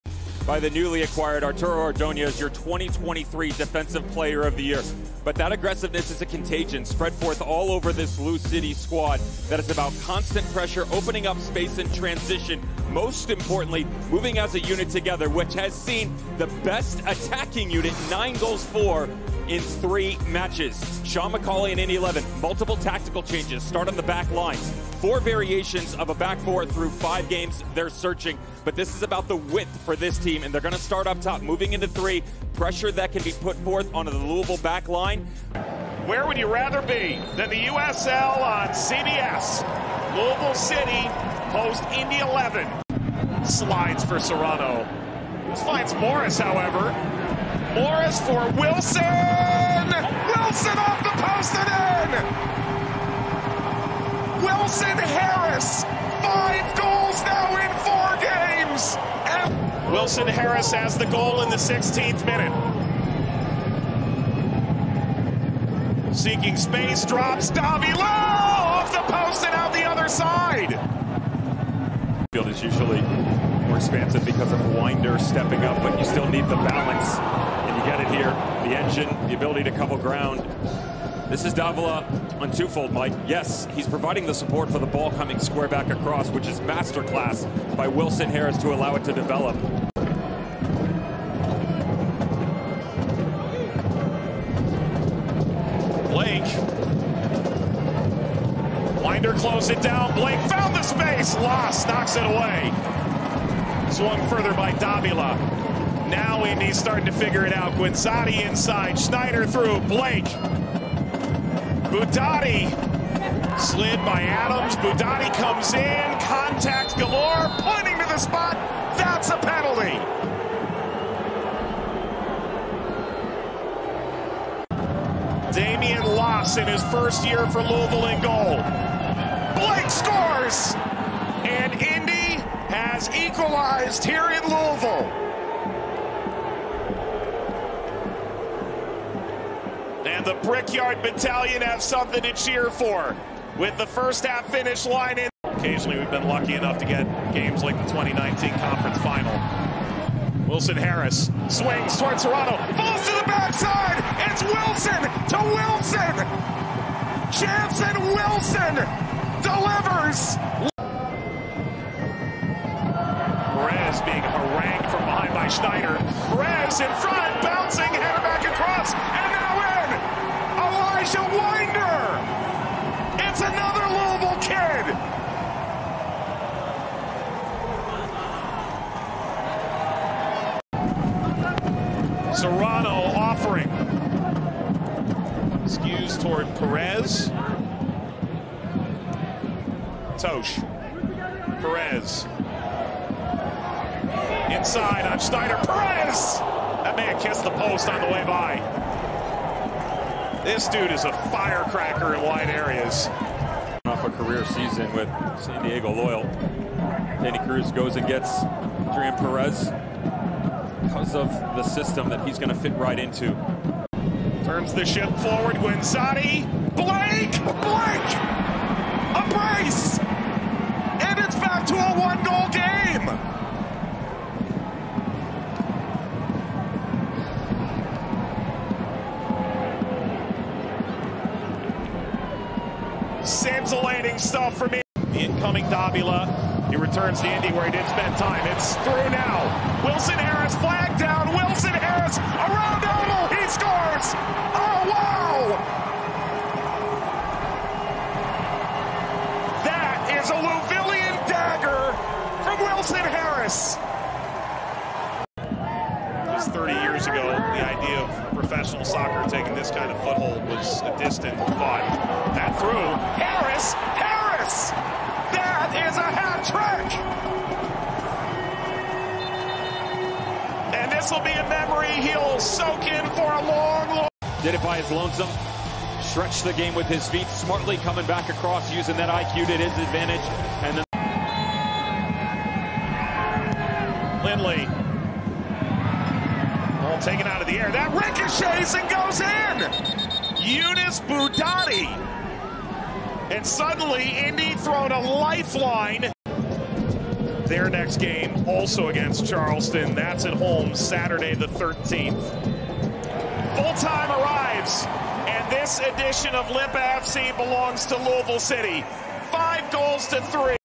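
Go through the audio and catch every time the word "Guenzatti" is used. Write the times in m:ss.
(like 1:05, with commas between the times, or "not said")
1:47, 3:35.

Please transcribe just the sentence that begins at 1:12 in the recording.
Field is usually more expansive because of Winder stepping up, but you still need the balance here.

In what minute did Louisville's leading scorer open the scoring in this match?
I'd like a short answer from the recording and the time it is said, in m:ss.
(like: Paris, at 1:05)
16th, at 1:01.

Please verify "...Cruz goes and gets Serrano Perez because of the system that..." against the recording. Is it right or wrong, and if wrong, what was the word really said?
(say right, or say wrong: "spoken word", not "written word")
wrong: "Adrien", not "Serrano".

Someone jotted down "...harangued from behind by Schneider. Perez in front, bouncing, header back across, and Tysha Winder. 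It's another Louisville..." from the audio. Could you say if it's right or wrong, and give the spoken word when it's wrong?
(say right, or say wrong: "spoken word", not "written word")
right.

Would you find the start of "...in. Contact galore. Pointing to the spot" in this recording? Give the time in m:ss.
1:55.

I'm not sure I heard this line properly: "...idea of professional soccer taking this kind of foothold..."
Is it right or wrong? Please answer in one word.
right.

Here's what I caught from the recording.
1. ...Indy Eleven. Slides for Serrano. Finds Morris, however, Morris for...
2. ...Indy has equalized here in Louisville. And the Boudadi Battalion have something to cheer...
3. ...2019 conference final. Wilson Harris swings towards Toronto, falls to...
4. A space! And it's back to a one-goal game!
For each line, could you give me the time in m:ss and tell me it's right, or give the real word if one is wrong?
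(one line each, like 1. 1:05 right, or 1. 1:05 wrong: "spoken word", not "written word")
1. 0:41 right
2. 2:11 wrong: "Brickyard", not "Boudadi"
3. 2:27 right
4. 3:39 wrong: "brace", not "space".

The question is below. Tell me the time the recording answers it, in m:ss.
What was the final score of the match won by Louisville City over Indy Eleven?
5:09.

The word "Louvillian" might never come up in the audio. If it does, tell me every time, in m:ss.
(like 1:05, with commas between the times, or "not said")
4:10.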